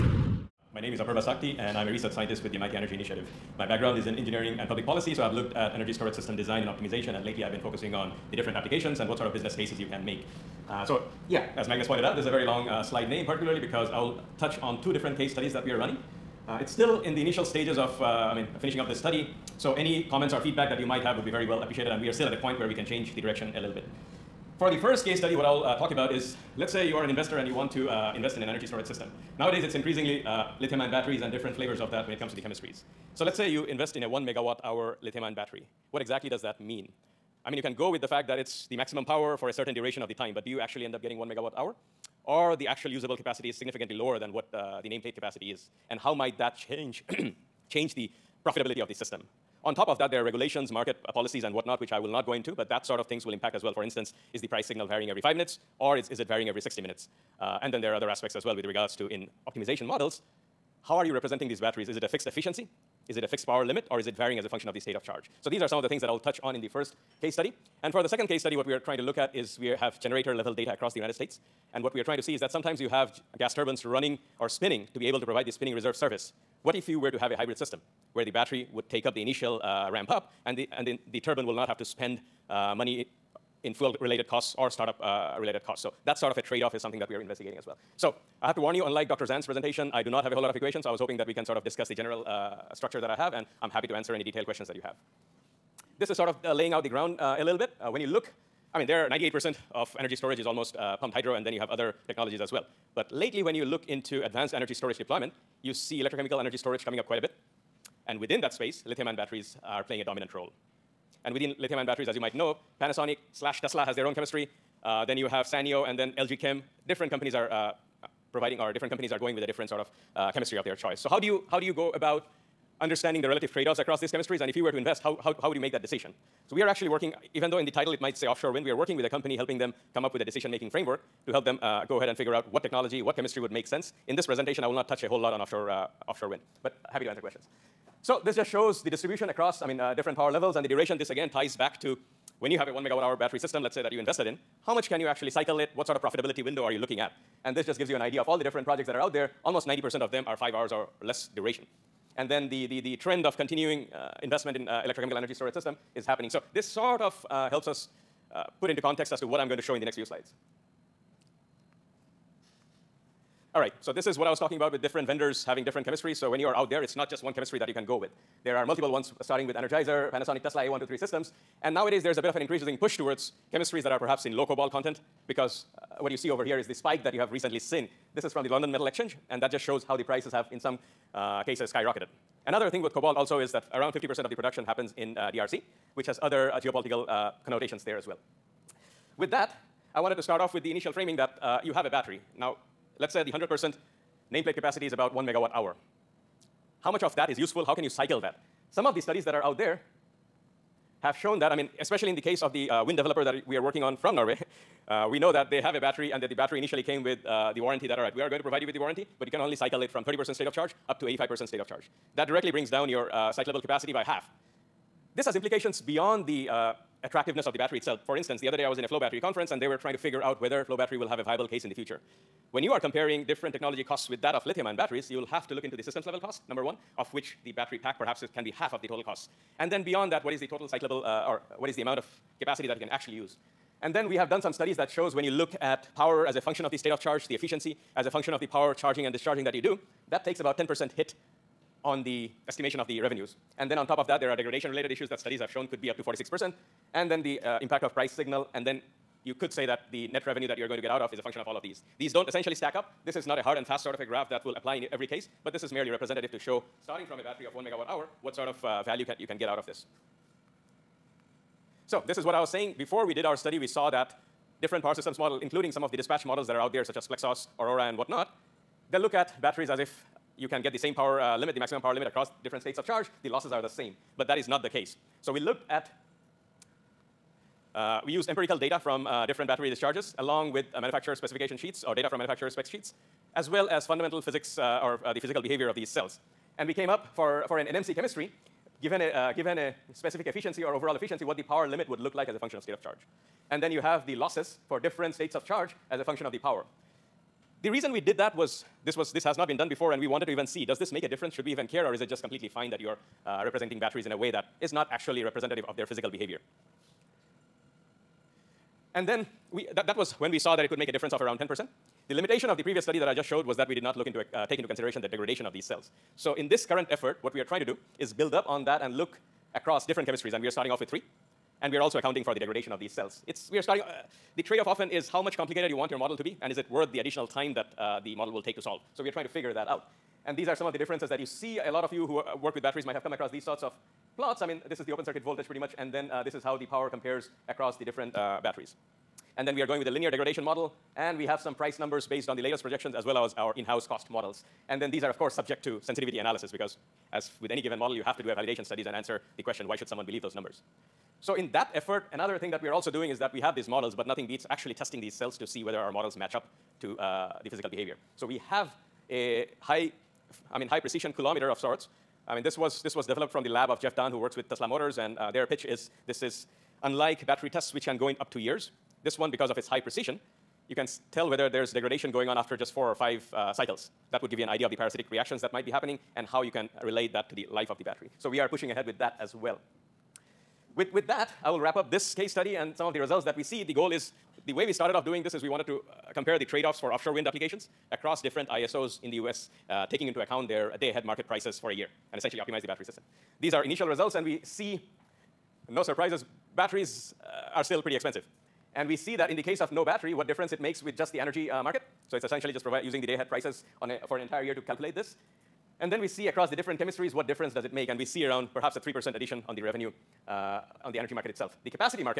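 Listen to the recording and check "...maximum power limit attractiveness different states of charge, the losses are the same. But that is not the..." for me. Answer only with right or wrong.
wrong.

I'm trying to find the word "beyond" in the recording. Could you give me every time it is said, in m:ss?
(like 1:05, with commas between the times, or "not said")
3:35, 3:49.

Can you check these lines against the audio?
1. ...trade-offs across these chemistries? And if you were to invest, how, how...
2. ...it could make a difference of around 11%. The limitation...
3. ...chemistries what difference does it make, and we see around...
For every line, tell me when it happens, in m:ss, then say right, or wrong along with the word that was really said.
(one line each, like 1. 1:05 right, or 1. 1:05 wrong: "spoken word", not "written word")
1. 2:03 right
2. 5:10 wrong: "10", not "11"
3. 6:46 right.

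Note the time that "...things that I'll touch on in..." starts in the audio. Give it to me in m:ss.
1:05.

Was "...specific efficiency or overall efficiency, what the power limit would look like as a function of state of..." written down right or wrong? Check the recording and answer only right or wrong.
right.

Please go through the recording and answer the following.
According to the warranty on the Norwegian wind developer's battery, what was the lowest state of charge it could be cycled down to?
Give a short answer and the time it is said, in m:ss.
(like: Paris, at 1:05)
30%, at 3:30.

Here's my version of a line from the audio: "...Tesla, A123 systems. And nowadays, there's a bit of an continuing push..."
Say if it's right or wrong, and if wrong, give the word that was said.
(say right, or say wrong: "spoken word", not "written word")
wrong: "increasing", not "continuing".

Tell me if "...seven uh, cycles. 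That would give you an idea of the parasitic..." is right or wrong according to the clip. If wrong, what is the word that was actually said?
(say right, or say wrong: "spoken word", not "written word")
wrong: "five", not "seven".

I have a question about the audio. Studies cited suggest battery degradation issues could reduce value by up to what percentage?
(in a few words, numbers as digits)
46%.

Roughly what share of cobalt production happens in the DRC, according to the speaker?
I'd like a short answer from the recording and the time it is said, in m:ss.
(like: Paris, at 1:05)
50%, at 3:03.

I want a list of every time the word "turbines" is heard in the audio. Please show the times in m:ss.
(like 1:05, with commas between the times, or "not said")
1:13, 1:21.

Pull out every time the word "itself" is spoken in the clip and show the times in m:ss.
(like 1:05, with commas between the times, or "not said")
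3:37, 6:51.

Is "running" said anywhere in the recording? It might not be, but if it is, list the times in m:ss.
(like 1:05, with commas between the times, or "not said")
0:15, 1:13.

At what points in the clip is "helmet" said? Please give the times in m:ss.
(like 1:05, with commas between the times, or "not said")
not said.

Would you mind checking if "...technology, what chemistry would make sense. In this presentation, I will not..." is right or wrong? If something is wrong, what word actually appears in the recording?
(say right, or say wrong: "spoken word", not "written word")
right.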